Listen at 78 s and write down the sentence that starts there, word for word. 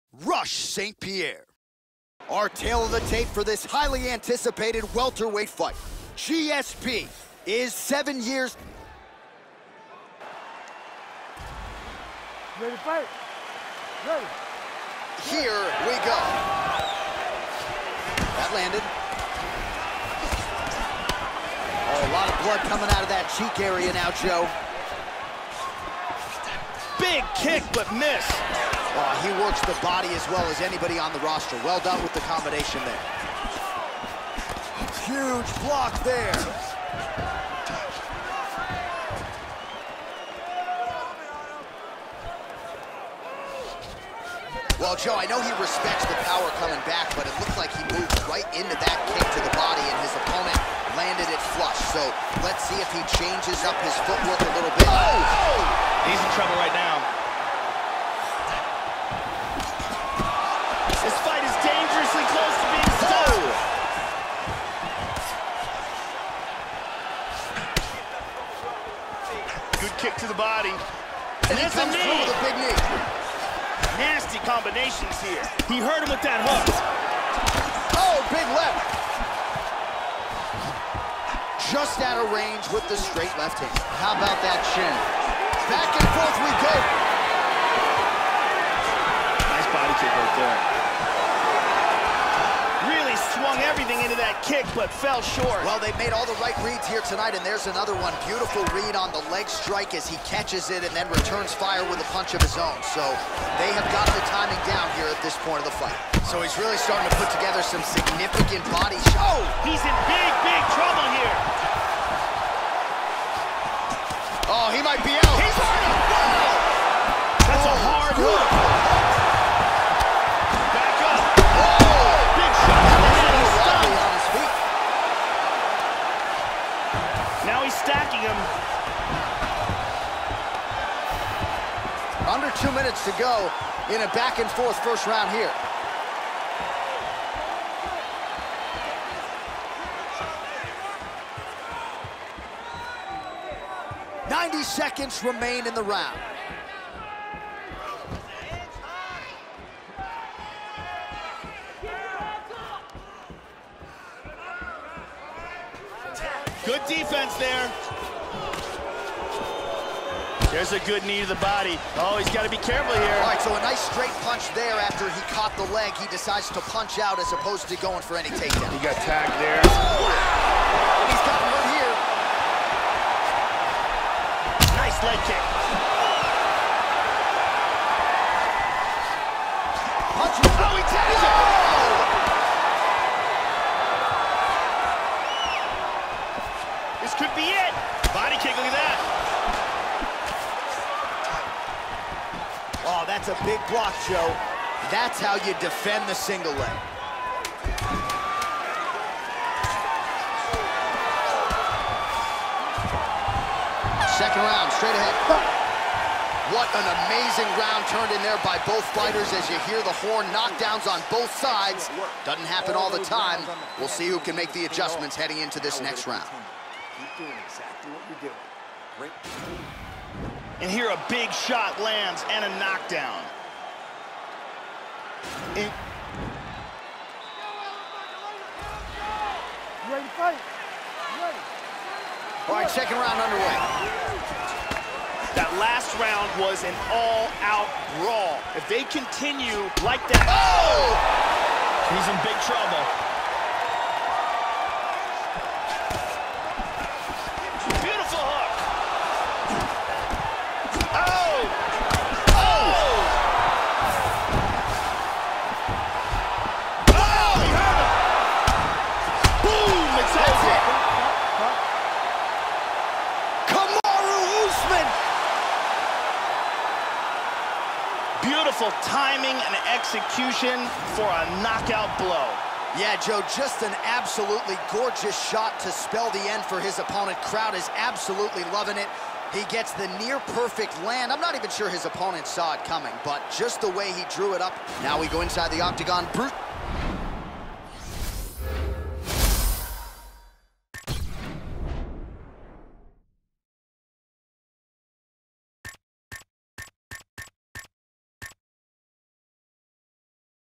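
Oh, big left just out of range with the straight left hand.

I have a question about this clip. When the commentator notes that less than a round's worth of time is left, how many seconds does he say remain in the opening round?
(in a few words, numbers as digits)
90.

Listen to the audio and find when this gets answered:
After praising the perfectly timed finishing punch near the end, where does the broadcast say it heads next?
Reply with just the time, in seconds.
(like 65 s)
285 s.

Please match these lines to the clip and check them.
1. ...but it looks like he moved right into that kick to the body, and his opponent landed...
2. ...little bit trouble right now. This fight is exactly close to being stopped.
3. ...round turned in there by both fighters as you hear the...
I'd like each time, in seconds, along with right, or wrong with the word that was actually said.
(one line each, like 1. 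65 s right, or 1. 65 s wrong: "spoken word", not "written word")
1. 47 s right
2. 54 s wrong: "dangerously", not "exactly"
3. 207 s right.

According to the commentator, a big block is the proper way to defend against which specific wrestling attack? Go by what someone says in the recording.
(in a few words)
single leg.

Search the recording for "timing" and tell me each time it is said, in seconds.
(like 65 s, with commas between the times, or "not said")
104 s, 268 s.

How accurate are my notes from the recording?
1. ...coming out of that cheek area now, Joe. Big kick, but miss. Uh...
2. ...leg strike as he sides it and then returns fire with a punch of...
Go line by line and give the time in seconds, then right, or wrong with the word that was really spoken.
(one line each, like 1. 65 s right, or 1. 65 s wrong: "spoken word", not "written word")
1. 22 s right
2. 99 s wrong: "catches", not "sides".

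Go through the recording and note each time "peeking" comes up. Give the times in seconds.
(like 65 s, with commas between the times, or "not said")
not said.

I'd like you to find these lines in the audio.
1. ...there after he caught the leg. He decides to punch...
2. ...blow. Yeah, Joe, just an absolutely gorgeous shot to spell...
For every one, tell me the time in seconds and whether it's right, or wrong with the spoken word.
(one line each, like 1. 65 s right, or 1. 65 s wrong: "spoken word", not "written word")
1. 164 s right
2. 271 s right.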